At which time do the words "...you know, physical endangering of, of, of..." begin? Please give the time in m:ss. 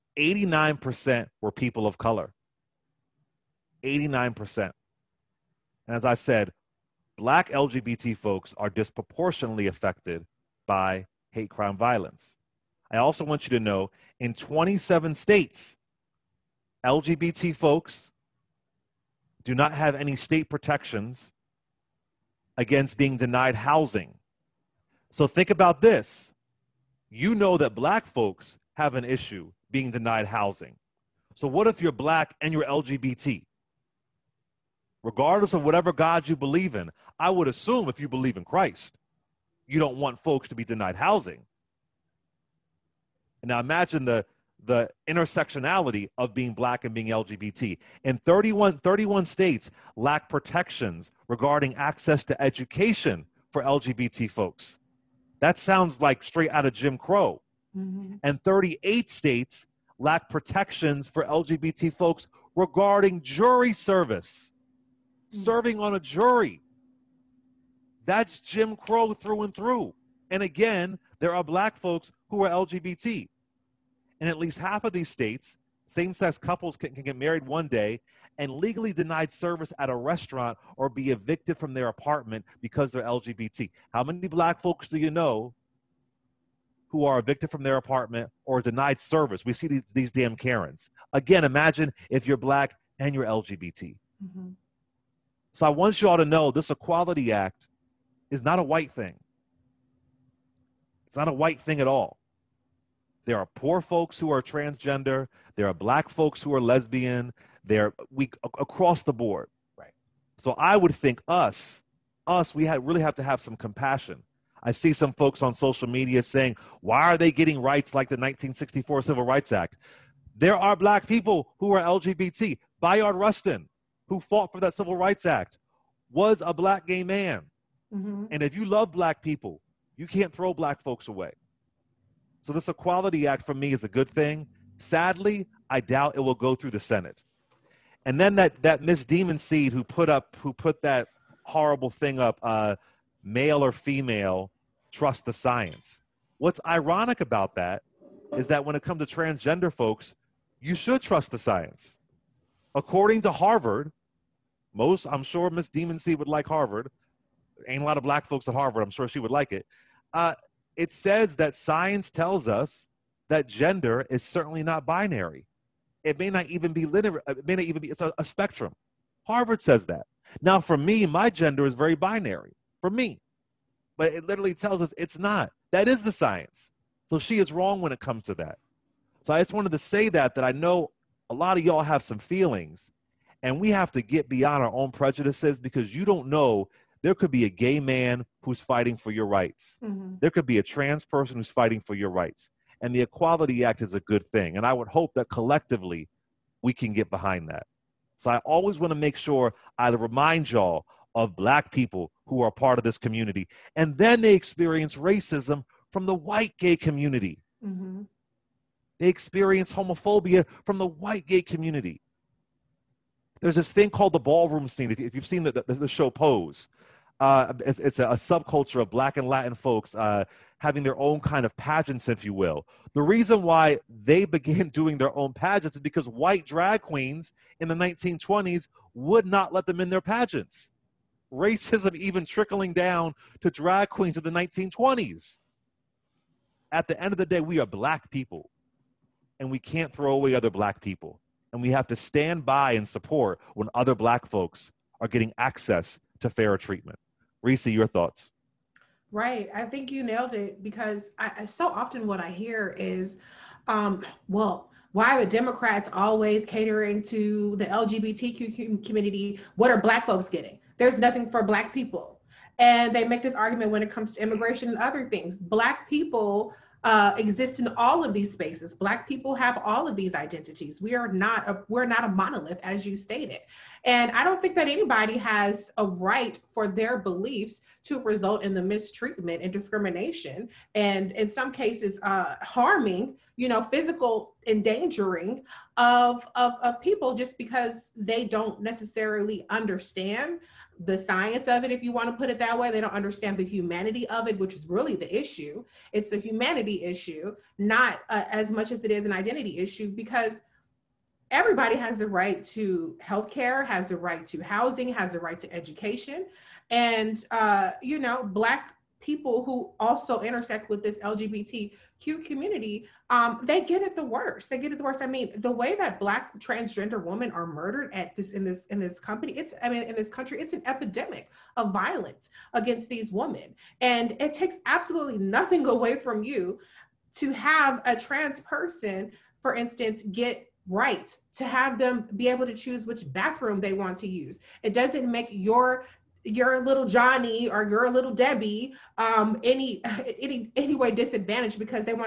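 4:43.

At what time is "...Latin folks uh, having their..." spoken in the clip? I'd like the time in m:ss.
3:39.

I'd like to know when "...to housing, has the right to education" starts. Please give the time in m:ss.
5:04.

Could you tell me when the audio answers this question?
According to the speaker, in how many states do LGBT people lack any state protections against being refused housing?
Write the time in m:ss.
0:14.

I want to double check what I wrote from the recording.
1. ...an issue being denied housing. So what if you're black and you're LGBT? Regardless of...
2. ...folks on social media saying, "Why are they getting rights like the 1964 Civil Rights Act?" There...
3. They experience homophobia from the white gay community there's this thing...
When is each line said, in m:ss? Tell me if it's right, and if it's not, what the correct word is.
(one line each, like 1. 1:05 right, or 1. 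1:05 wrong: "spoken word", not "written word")
1. 0:28 right
2. 1:55 right
3. 3:28 right.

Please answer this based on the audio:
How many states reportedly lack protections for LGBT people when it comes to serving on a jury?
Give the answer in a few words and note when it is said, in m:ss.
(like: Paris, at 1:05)
38, at 0:58.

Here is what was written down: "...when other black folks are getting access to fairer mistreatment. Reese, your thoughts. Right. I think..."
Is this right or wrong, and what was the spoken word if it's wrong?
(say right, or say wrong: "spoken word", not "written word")
wrong: "treatment", not "mistreatment".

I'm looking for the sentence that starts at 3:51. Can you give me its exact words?
Racism even trickling down to drag queens in the 1920s.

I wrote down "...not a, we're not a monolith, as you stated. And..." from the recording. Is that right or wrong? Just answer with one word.
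right.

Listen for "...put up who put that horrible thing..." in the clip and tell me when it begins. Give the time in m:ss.
2:19.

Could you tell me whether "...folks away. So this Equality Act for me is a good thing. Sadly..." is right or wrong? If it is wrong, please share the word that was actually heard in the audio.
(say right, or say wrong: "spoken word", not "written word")
right.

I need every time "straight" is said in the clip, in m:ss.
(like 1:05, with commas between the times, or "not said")
0:56.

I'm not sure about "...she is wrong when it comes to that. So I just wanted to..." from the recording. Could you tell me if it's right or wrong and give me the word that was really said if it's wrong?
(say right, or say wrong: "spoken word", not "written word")
right.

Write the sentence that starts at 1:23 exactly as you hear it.
How many black folks do you know who are evicted from their apartment or denied service?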